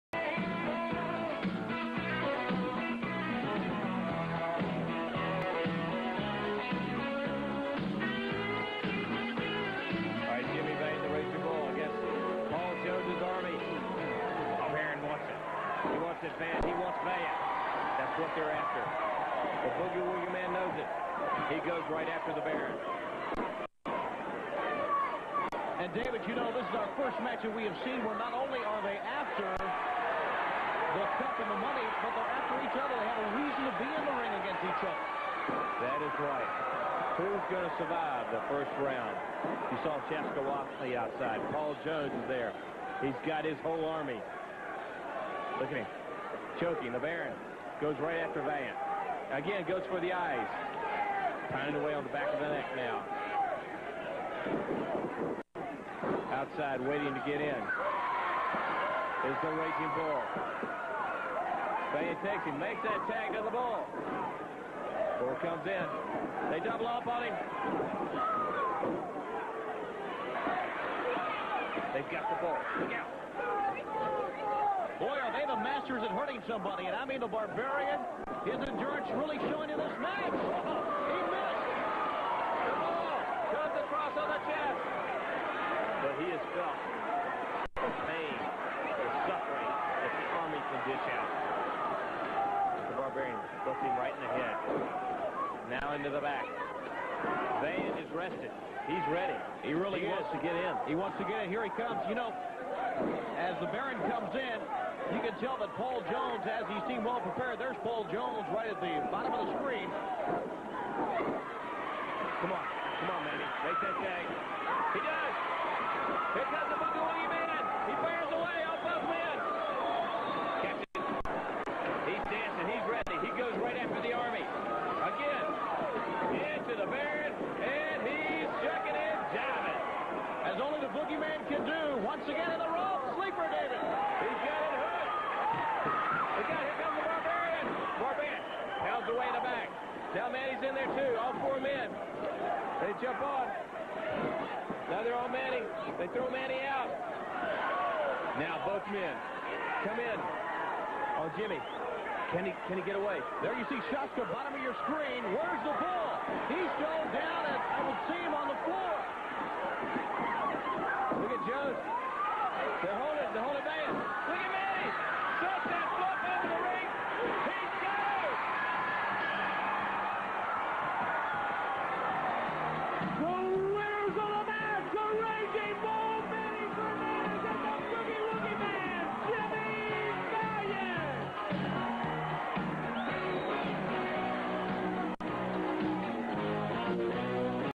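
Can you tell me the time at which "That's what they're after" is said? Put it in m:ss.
0:17.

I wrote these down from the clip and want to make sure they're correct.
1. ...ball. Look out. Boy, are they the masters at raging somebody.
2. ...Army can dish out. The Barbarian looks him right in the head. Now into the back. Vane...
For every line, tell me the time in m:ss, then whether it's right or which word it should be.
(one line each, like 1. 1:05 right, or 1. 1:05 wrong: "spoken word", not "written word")
1. 1:12 wrong: "hurting", not "raging"
2. 1:30 right.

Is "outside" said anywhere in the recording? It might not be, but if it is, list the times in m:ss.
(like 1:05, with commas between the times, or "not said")
0:40, 0:56.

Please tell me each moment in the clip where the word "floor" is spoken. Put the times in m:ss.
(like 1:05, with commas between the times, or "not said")
2:38.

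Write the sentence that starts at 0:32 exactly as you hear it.
They have a reason to be in the ring against each other.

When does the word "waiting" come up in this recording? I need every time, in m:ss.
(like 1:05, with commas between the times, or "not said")
0:56.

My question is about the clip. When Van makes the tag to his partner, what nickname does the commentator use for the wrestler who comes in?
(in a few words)
The raging bull.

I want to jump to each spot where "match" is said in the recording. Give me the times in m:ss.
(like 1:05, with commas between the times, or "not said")
0:27, 1:19.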